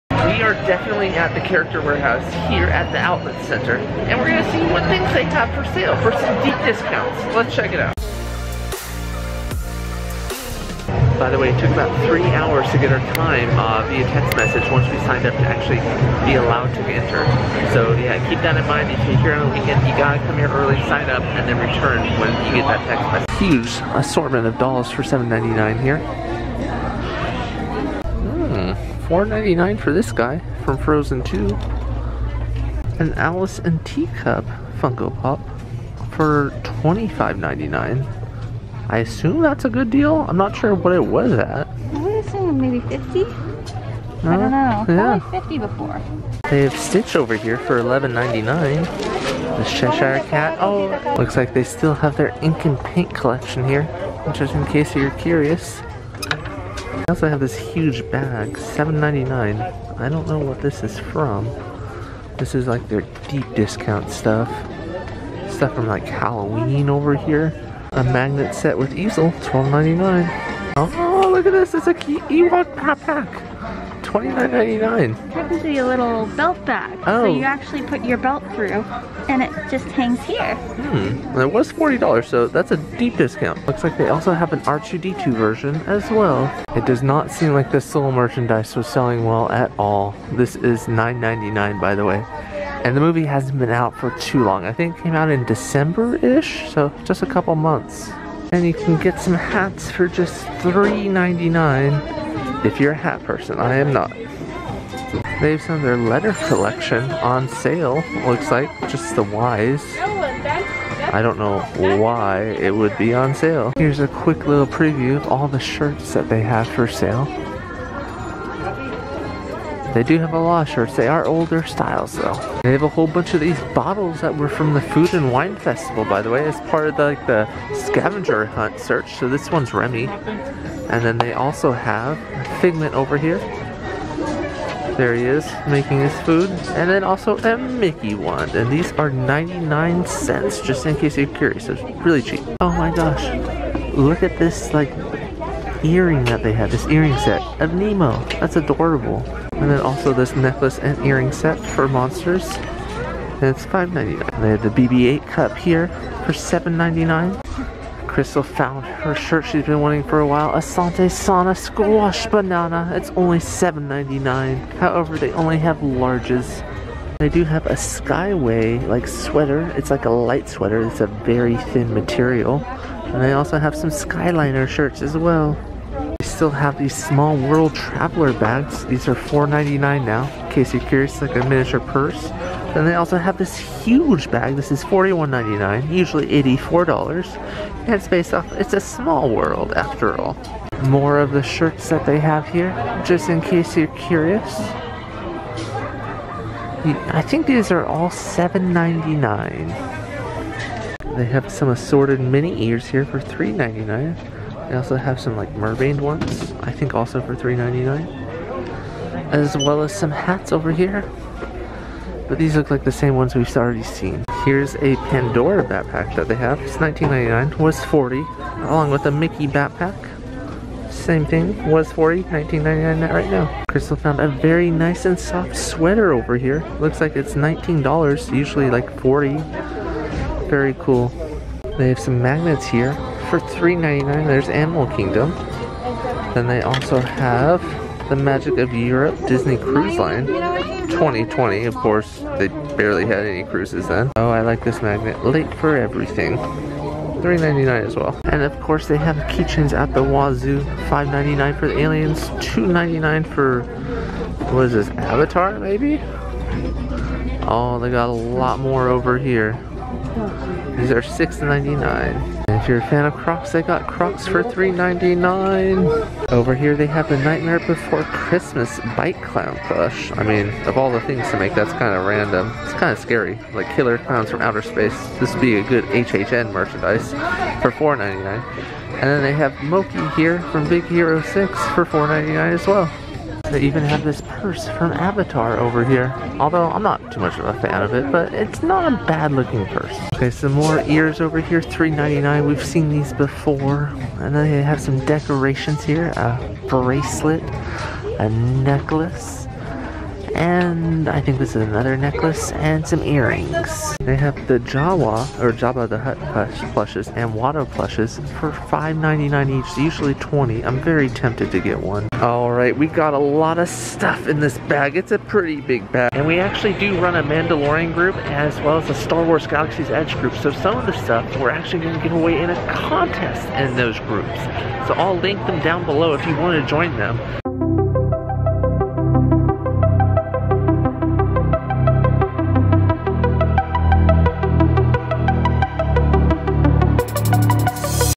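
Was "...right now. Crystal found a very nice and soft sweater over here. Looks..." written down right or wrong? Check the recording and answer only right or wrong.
right.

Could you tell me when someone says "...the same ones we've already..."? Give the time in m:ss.
3:32.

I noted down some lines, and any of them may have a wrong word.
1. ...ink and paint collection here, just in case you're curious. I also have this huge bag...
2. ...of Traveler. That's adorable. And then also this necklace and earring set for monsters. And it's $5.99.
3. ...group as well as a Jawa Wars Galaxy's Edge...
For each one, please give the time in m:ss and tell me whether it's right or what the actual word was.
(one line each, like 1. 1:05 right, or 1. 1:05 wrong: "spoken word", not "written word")
1. 0:52 right
2. 2:27 wrong: "Nemo", not "Traveler"
3. 5:17 wrong: "Star", not "Jawa".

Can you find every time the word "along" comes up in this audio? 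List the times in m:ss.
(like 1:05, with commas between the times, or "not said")
3:38.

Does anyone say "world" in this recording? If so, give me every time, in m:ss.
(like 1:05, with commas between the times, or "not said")
2:57, 3:09.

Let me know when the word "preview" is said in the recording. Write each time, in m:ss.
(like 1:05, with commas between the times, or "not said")
1:54.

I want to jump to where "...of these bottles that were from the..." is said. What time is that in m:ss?
2:03.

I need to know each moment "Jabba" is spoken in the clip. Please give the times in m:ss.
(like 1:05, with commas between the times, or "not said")
5:05.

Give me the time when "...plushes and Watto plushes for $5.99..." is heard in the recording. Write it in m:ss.
5:06.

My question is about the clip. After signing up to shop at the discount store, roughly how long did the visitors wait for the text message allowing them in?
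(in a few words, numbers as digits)
3 hours.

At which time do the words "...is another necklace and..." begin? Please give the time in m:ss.
5:01.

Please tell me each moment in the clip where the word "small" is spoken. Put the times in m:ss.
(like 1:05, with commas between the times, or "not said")
2:56, 3:08.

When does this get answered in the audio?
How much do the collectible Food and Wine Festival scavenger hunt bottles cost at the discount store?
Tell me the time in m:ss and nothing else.
2:19.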